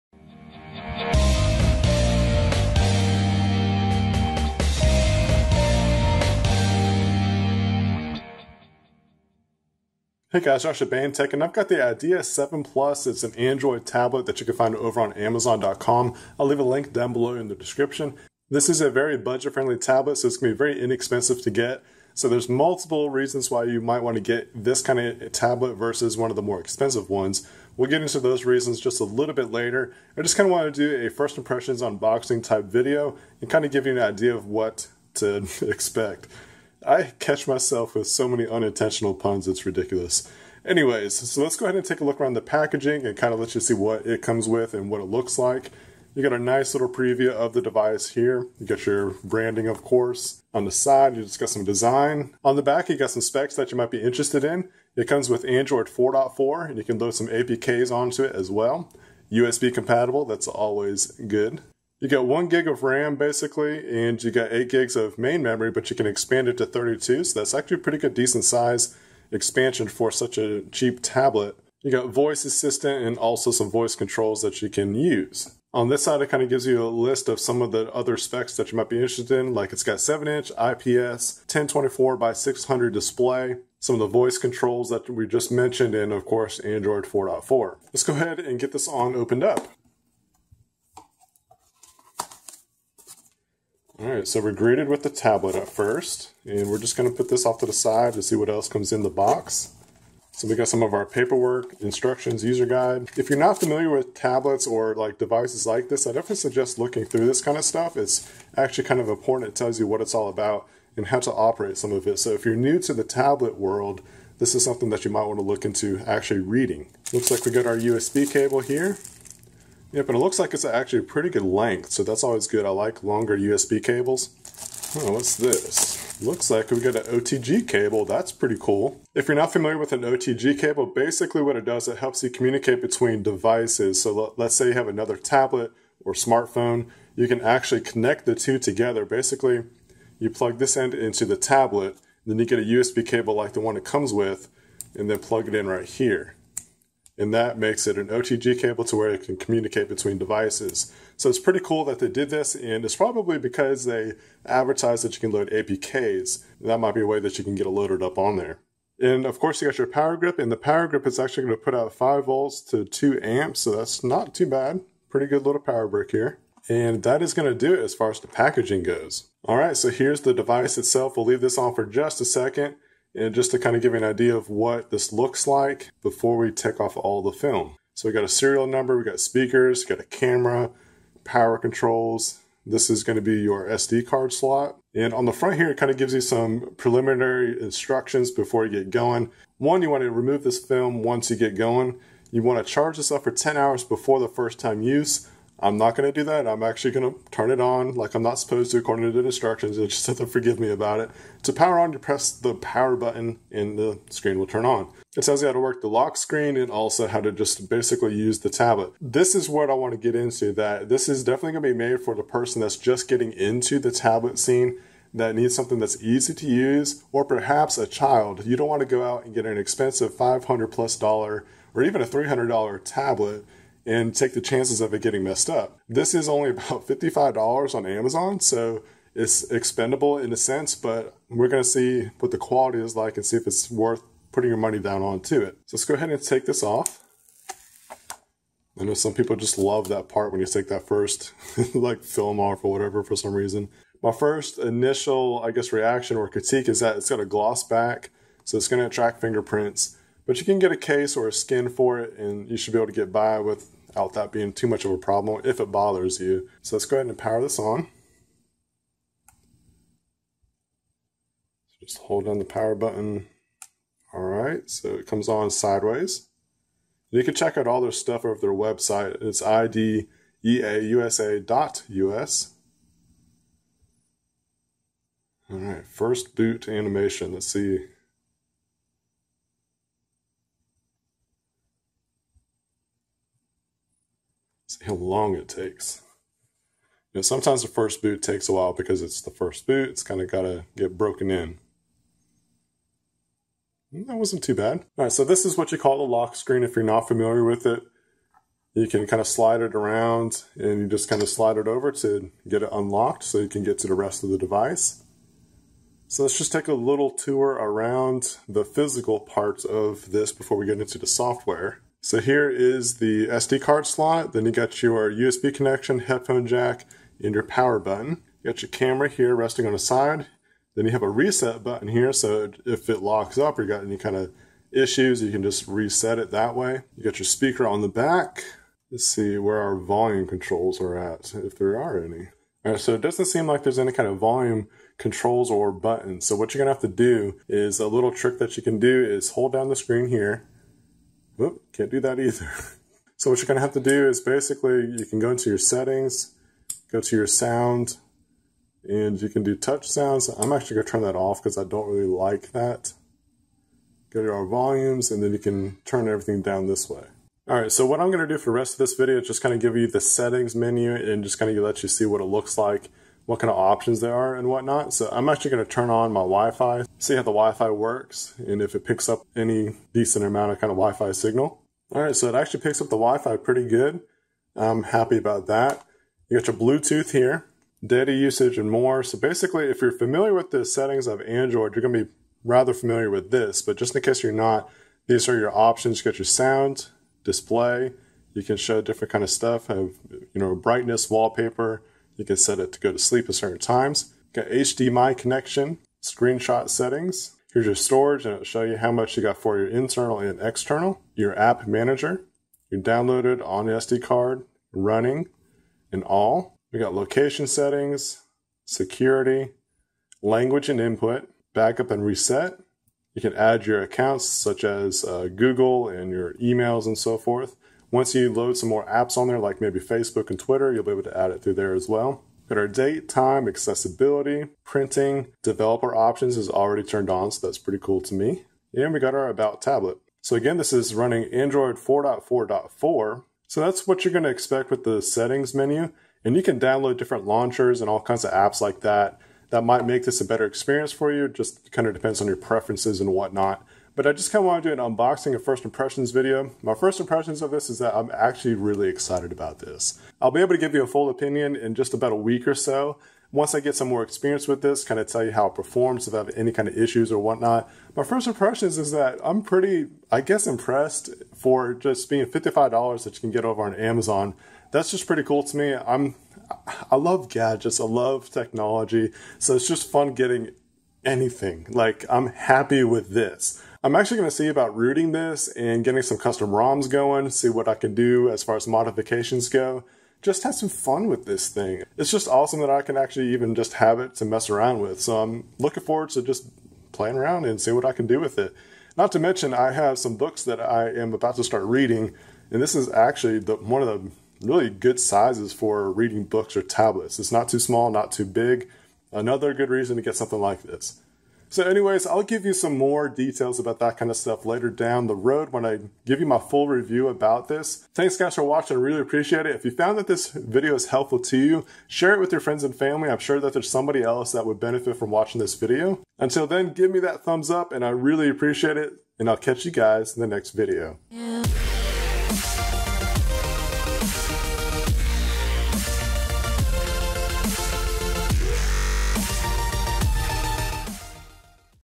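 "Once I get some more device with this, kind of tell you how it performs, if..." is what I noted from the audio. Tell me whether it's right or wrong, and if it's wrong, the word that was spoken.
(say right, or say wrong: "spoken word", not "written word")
wrong: "experience", not "device".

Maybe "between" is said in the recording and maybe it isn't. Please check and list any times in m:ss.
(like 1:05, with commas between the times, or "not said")
2:12, 2:29.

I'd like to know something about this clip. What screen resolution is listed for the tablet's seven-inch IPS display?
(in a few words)
1024 by 600.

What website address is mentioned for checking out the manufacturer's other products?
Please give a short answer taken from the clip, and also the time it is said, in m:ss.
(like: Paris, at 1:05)
ideausa.us, at 4:29.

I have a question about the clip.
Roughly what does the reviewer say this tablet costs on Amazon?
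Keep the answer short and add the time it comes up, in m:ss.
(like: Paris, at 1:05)
$55, at 3:46.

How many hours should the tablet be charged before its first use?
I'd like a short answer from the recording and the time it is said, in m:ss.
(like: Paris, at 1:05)
10, at 3:13.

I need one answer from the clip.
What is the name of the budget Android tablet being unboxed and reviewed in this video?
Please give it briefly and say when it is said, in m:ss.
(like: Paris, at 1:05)
Idea 7 Plus, at 0:11.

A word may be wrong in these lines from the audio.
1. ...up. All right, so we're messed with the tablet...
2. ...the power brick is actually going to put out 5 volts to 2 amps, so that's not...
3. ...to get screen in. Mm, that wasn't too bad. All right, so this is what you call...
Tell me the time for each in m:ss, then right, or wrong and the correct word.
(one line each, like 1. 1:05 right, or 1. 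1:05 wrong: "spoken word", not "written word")
1. 1:29 wrong: "greeted", not "messed"
2. 2:40 right
3. 4:50 wrong: "broken", not "screen".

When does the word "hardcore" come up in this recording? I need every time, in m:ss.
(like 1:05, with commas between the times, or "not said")
not said.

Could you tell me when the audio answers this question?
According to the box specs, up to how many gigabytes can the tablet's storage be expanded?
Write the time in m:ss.
1:06.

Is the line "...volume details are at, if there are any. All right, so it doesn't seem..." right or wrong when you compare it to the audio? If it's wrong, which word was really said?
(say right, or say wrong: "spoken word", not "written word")
wrong: "controls", not "details".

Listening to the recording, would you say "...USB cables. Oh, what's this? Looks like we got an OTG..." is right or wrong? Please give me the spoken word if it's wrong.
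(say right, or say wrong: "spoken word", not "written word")
right.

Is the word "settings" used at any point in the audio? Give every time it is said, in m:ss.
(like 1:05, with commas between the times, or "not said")
5:45, 6:00, 6:20, 6:36, 6:47, 7:15.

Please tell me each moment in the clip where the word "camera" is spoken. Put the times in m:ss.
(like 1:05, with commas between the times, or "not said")
3:00, 5:18.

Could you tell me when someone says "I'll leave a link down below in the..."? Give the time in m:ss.
0:16.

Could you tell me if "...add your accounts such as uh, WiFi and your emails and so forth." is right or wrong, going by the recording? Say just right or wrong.
wrong.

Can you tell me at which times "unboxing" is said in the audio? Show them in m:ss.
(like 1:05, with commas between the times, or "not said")
0:31, 7:24.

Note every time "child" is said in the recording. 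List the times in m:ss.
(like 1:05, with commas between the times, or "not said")
3:37.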